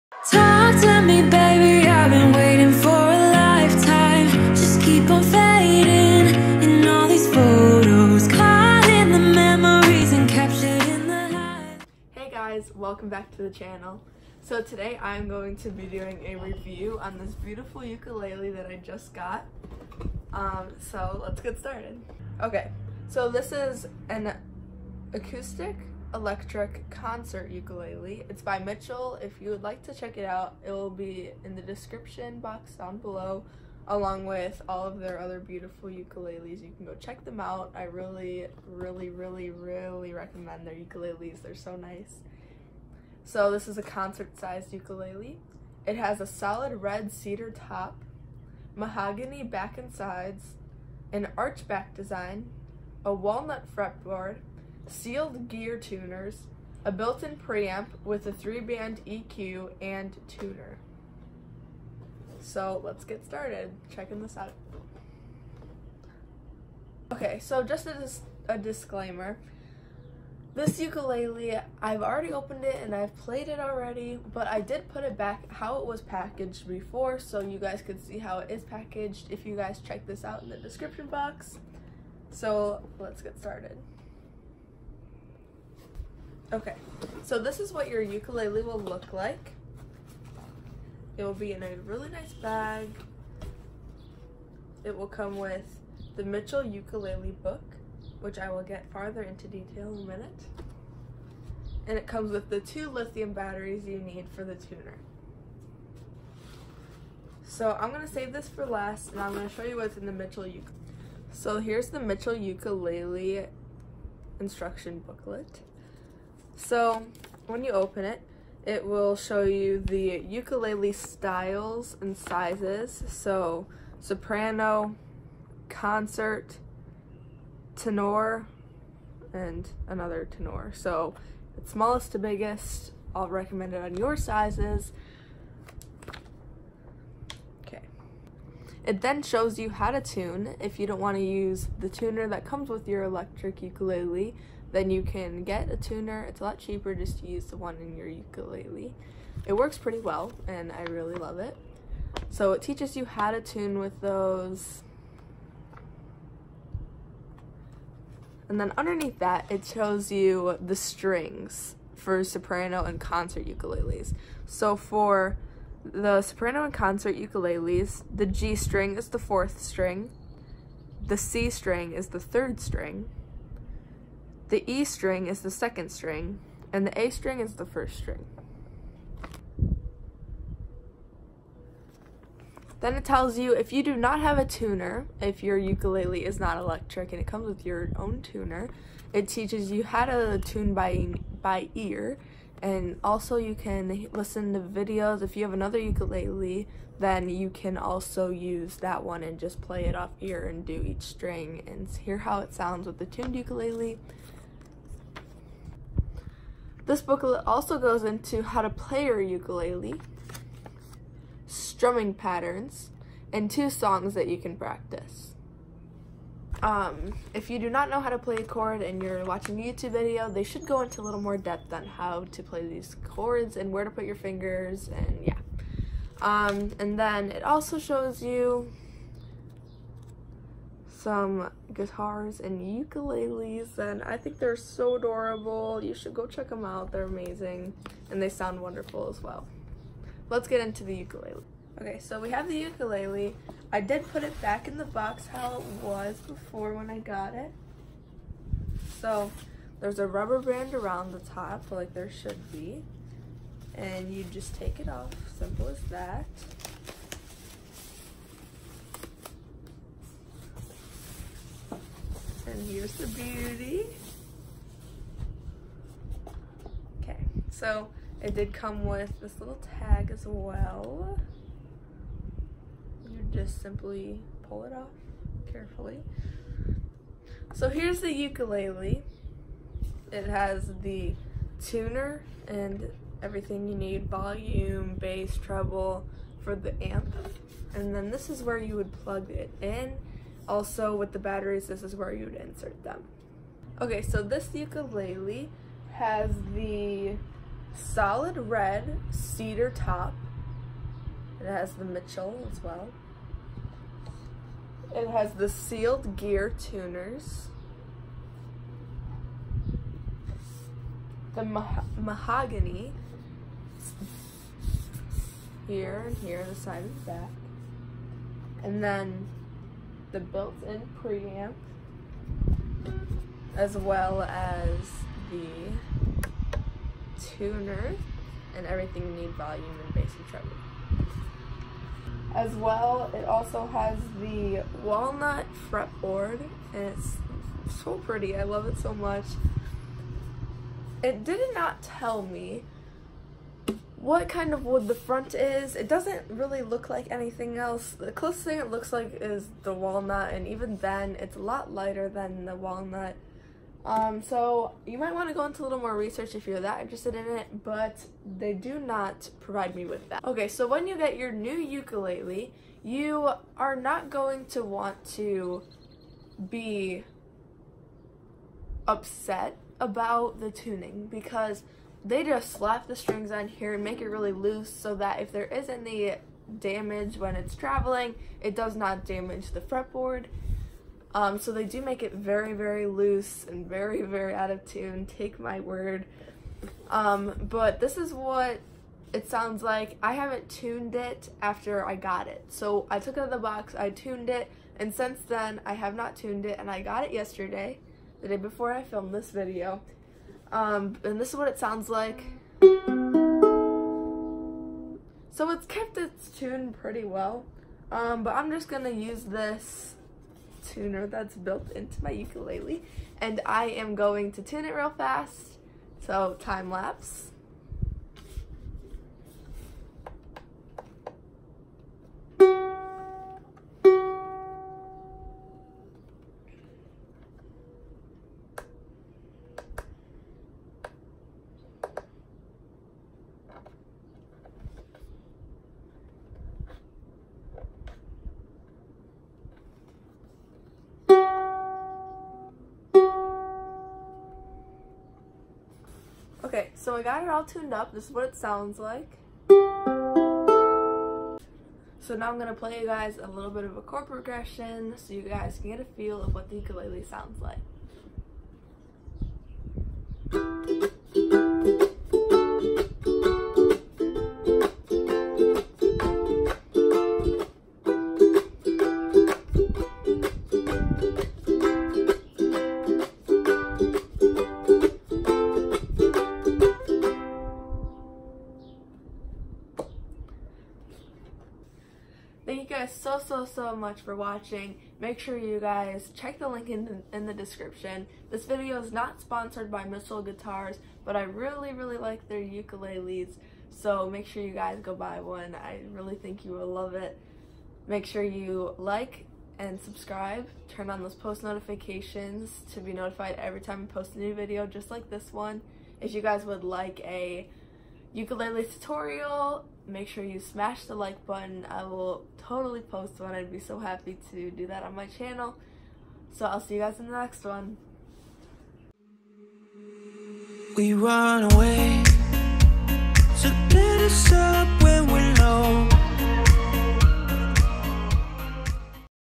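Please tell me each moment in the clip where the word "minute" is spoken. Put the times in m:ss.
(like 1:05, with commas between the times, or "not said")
1:40.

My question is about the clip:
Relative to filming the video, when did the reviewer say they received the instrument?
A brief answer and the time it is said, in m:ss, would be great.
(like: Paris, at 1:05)
yesterday, at 6:37.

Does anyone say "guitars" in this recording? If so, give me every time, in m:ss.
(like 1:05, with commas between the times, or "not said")
3:51, 8:10.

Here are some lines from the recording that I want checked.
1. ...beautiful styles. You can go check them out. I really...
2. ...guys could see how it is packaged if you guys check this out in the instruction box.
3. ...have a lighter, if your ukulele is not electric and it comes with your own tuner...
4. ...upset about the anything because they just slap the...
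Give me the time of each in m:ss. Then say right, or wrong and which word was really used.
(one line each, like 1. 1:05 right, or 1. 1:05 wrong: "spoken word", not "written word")
1. 0:35 wrong: "ukuleles", not "styles"
2. 1:17 wrong: "description", not "instruction"
3. 3:04 wrong: "tuner", not "lighter"
4. 6:08 wrong: "tuning", not "anything".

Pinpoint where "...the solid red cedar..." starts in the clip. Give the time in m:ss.
4:56.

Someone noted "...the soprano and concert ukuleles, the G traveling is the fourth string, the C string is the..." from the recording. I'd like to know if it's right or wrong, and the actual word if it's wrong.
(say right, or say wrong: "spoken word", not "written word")
wrong: "string", not "traveling".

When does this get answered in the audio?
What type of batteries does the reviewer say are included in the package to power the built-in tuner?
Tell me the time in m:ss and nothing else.
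1:42.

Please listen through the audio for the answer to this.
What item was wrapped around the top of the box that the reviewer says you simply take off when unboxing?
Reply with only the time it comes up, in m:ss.
4:10.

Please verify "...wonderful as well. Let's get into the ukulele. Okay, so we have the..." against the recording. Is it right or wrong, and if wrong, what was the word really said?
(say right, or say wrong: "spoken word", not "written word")
right.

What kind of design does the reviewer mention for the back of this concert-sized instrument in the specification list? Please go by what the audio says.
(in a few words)
archback.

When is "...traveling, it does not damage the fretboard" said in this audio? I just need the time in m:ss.
6:17.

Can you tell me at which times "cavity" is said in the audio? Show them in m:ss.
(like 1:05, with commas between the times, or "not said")
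not said.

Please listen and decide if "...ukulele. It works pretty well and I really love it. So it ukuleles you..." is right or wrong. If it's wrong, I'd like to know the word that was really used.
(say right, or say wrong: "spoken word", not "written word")
wrong: "teaches", not "ukuleles".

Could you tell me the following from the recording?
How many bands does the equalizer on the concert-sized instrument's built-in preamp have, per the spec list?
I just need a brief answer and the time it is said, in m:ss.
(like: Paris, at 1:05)
3, at 0:58.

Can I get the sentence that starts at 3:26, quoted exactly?
This booklet also goes into how to play your ukulele, strumming patterns, and two songs that you can practice.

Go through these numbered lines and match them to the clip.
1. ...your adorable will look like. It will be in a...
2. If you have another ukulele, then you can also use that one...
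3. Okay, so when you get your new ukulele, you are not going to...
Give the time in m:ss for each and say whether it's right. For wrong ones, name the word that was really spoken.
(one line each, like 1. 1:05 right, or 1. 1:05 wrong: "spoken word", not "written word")
1. 1:27 wrong: "ukulele", not "adorable"
2. 3:15 right
3. 6:00 right.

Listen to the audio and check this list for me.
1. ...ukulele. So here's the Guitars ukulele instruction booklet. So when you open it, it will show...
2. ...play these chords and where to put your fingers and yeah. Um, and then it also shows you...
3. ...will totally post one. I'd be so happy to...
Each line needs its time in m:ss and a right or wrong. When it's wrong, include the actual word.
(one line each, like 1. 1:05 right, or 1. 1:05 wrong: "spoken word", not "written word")
1. 1:50 wrong: "Mitchell", not "Guitars"
2. 3:42 right
3. 8:31 right.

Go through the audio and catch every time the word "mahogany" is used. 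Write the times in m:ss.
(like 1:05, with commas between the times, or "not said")
0:48, 5:11.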